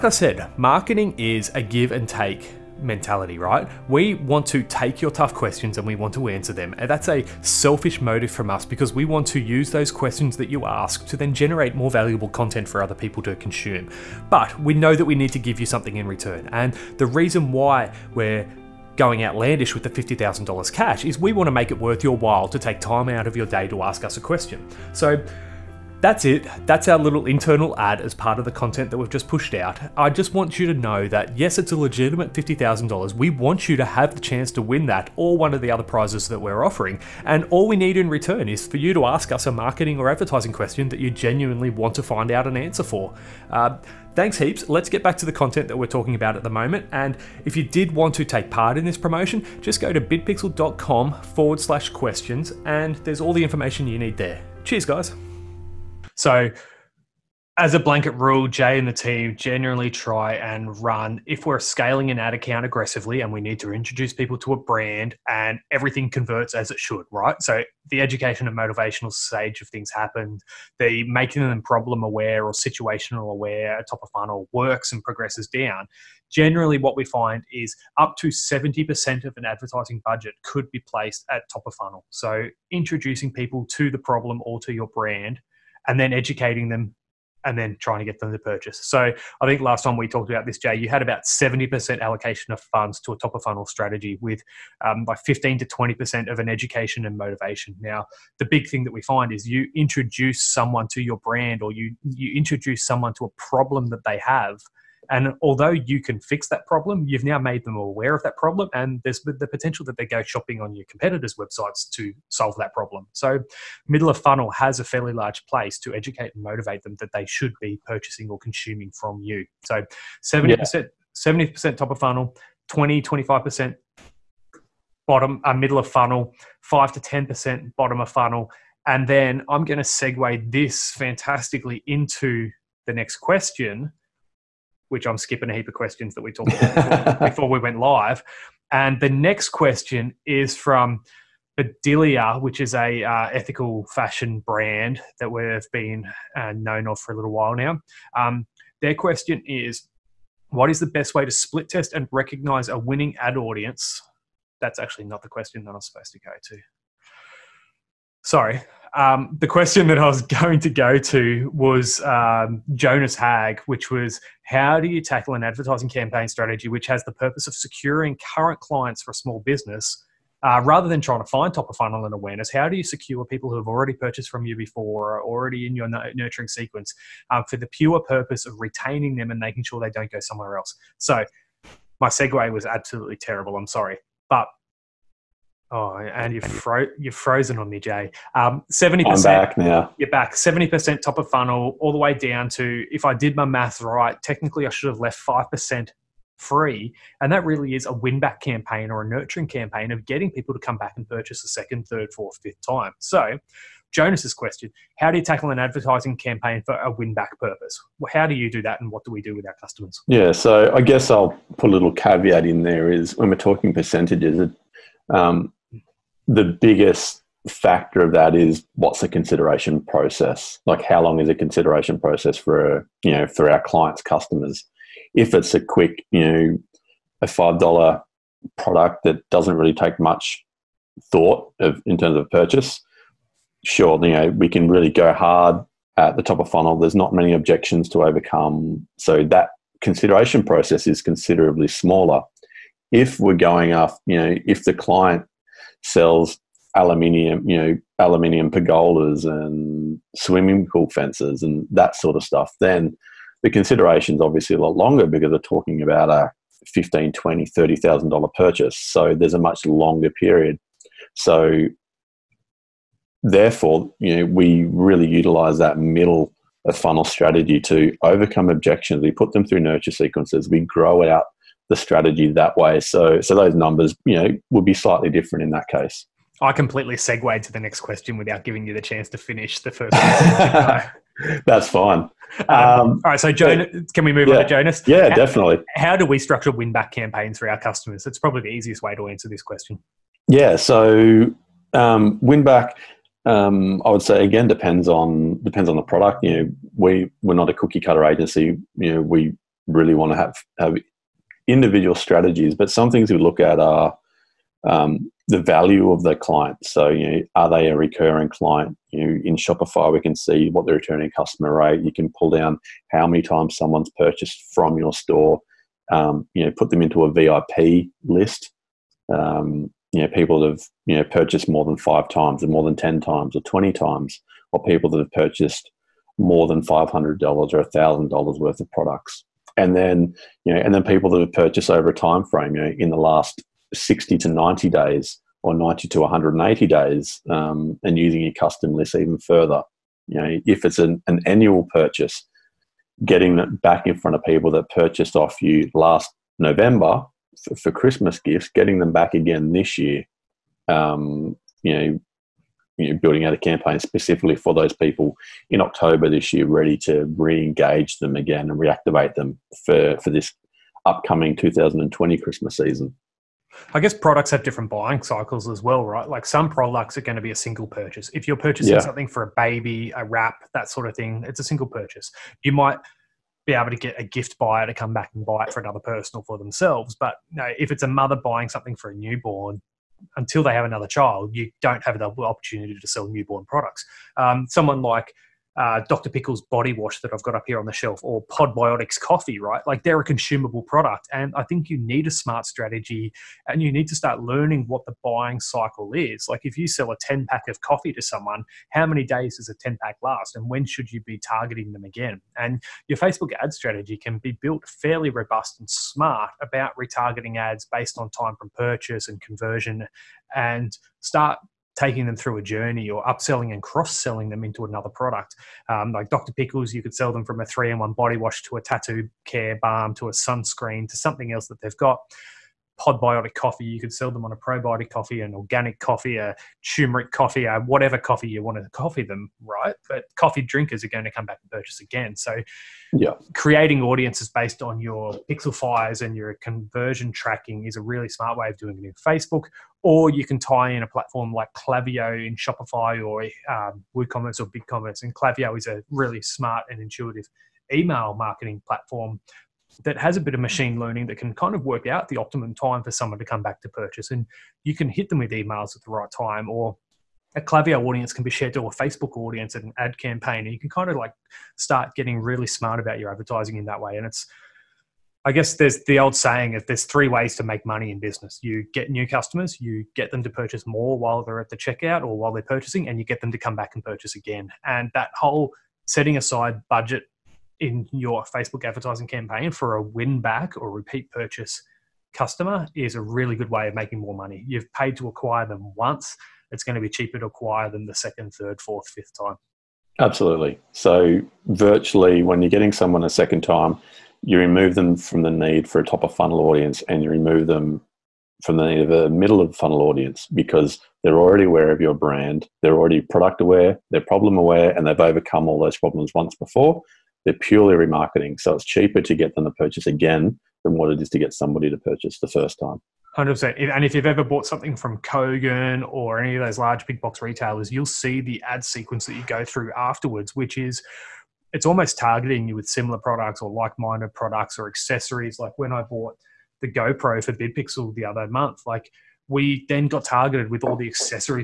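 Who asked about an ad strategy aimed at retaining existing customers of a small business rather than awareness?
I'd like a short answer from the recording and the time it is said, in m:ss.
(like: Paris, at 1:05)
Jonas Haag, at 2:42.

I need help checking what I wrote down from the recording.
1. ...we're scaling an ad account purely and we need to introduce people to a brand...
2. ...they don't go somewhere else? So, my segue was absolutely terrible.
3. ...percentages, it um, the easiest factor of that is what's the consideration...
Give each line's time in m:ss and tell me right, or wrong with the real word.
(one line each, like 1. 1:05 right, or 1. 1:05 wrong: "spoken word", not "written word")
1. 1:01 wrong: "aggressively", not "purely"
2. 2:59 right
3. 3:33 wrong: "biggest", not "easiest".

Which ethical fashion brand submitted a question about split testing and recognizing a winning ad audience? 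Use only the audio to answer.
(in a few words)
Bedelia.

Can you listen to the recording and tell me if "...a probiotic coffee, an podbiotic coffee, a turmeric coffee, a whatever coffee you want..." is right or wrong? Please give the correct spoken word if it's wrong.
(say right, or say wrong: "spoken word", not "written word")
wrong: "organic", not "podbiotic".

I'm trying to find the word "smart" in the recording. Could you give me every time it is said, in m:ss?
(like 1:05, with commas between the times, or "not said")
6:32, 6:45, 7:18, 7:26, 7:42.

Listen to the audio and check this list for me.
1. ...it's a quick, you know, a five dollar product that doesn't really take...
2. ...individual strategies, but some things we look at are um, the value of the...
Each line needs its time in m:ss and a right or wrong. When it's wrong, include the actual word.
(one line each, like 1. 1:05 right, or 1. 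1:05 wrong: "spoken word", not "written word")
1. 3:45 right
2. 5:01 right.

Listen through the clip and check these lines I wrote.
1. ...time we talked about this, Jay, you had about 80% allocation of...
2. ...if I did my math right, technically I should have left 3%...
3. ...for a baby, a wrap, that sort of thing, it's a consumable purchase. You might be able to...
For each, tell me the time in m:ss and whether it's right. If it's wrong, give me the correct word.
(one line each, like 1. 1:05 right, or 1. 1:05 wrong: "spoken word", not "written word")
1. 1:29 wrong: "70", not "80"
2. 3:12 wrong: "5", not "3"
3. 6:09 wrong: "single", not "consumable".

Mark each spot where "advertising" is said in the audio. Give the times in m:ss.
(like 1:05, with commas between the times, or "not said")
0:40, 1:19, 2:45, 3:25, 7:43, 7:58.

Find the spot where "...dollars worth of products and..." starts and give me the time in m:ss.
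5:28.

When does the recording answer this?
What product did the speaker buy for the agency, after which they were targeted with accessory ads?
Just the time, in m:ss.
8:46.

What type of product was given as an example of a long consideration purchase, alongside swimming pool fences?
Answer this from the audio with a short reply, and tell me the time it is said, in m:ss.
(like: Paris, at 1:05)
aluminium pergolas, at 4:07.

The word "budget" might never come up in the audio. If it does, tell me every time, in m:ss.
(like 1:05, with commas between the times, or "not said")
1:20, 7:56.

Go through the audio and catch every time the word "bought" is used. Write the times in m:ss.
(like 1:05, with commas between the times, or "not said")
8:34, 8:45.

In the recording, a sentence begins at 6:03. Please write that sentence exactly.
I guess products have different buying cycles as well, right?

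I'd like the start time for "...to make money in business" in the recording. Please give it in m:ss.
7:47.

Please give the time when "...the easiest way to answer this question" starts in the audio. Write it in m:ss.
4:48.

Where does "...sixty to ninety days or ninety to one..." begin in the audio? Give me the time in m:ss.
5:33.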